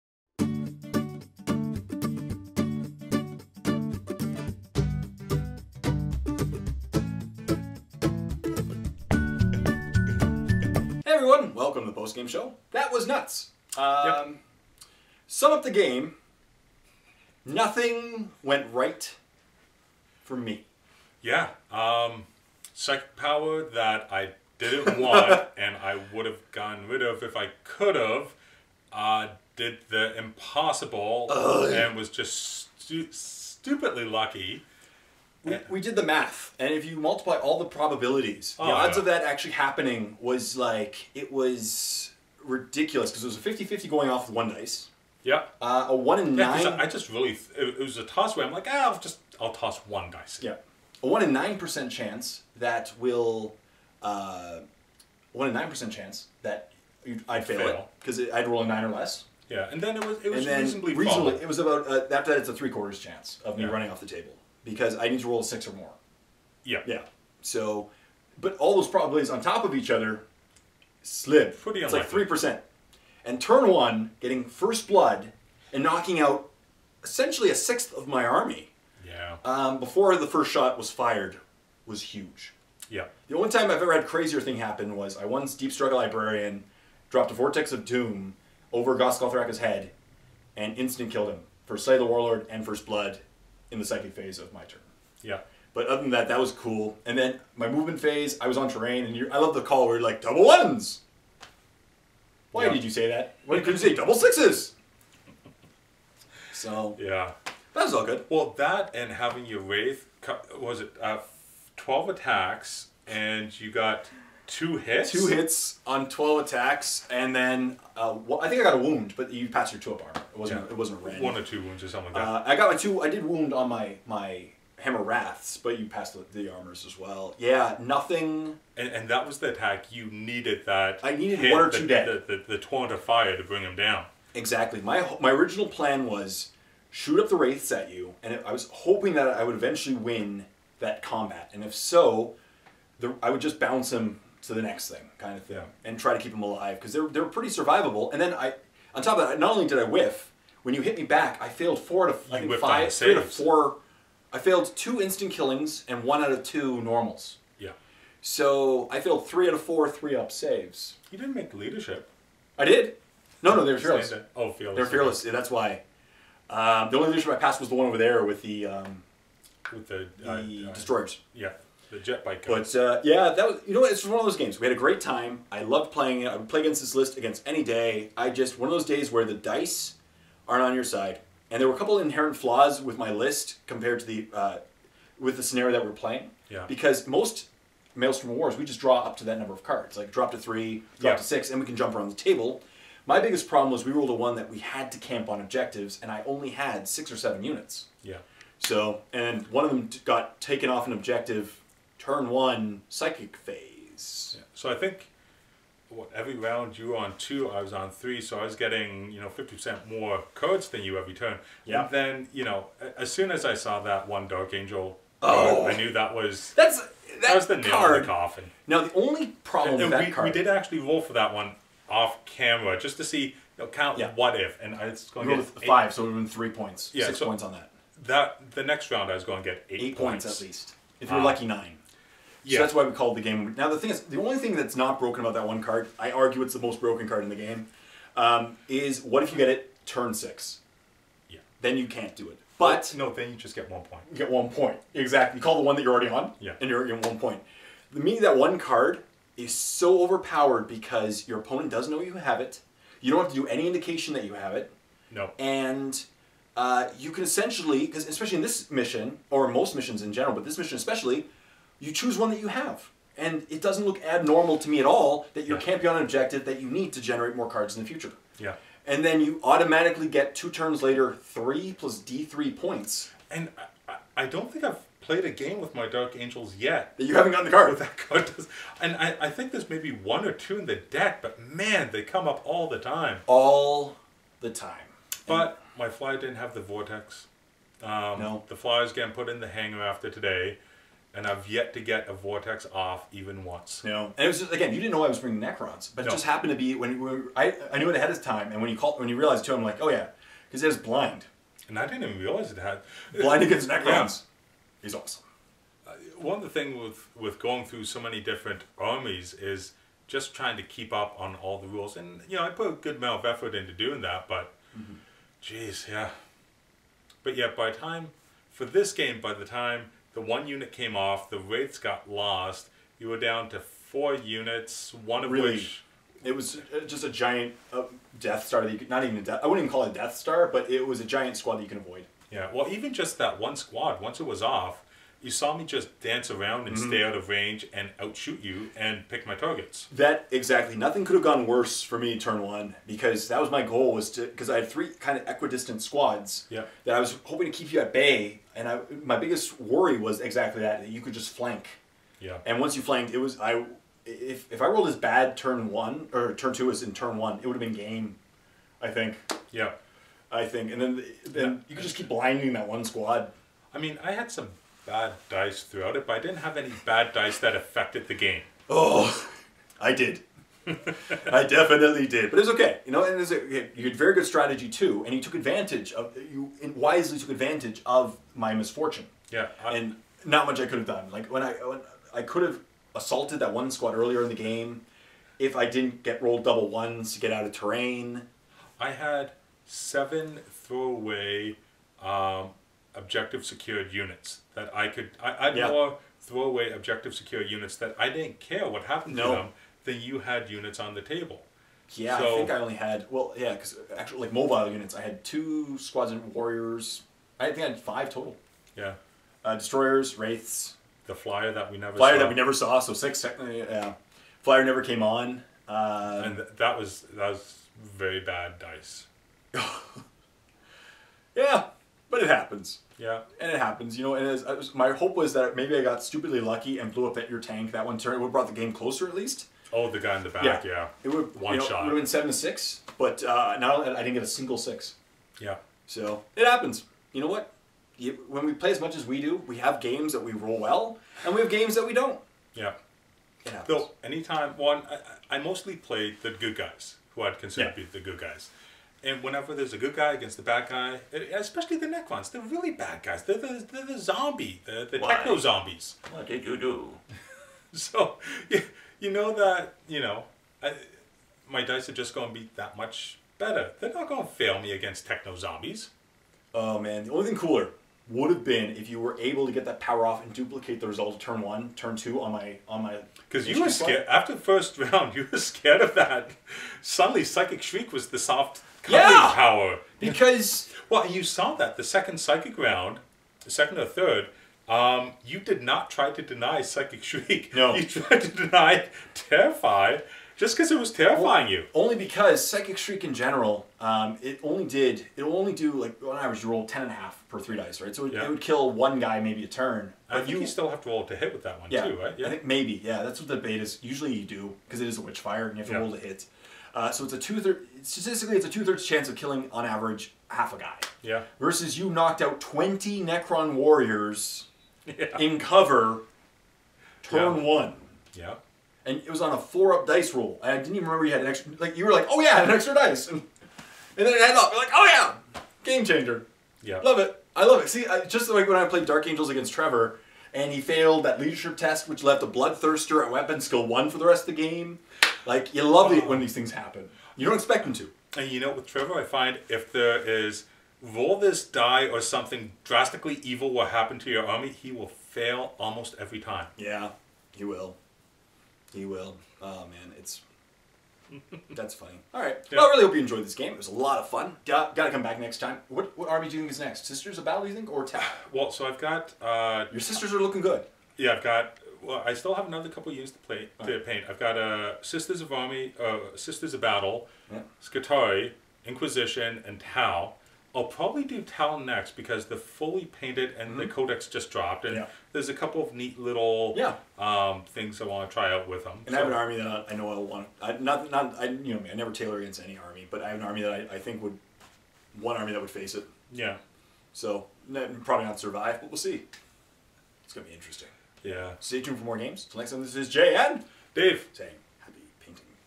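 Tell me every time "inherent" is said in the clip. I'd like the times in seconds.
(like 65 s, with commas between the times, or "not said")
181 s.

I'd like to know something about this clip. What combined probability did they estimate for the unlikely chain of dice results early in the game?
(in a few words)
3%.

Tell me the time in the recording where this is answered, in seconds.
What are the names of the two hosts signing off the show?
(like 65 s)
592 s.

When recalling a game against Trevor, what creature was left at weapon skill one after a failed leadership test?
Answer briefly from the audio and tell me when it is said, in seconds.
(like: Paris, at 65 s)
Bloodthirster, at 532 s.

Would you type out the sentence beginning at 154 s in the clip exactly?
I failed two instant killings and one out of two normals.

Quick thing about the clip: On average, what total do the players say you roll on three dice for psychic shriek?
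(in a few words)
10 and a half.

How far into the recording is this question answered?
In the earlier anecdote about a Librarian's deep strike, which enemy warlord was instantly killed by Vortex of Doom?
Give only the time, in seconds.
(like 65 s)
88 s.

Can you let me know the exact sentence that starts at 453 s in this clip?
They're the, they're the zombie, the, the techno zombies.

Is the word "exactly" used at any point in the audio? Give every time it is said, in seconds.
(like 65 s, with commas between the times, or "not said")
134 s, 244 s, 340 s, 350 s.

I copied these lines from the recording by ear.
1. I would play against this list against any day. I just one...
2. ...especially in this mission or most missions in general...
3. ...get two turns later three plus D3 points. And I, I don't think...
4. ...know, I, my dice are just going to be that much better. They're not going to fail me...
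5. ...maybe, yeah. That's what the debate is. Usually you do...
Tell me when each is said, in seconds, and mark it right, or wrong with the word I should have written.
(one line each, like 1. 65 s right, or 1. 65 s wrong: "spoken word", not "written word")
1. 176 s right
2. 258 s right
3. 270 s right
4. 459 s right
5. 502 s right.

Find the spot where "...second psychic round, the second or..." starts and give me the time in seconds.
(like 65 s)
481 s.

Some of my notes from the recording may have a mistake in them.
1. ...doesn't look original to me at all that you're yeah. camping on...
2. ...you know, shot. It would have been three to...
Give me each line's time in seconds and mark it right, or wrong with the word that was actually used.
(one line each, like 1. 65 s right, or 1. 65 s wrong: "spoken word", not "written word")
1. 263 s wrong: "abnormal", not "original"
2. 431 s wrong: "seven", not "three".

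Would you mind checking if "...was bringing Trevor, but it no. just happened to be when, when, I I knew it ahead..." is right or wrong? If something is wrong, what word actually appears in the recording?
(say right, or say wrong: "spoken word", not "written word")
wrong: "Necrons", not "Trevor".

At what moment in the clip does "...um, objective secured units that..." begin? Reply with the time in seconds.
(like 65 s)
392 s.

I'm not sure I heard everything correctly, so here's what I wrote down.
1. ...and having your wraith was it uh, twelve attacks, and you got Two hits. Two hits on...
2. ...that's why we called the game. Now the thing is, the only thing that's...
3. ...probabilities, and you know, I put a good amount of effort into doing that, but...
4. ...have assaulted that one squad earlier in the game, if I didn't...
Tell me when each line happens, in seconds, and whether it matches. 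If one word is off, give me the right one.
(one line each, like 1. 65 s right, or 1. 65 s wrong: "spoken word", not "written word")
1. 108 s right
2. 232 s right
3. 311 s wrong: "rules", not "probabilities"
4. 382 s right.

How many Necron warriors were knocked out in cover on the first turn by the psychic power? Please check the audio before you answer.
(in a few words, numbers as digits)
20.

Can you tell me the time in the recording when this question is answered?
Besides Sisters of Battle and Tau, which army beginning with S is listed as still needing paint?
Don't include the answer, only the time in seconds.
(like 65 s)
567 s.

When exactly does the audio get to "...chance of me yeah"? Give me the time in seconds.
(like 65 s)
62 s.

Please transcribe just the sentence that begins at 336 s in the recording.
stay out of range and outshoot you and pick my targets.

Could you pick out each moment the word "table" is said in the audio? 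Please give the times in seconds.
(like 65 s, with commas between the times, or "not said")
64 s, 192 s, 401 s.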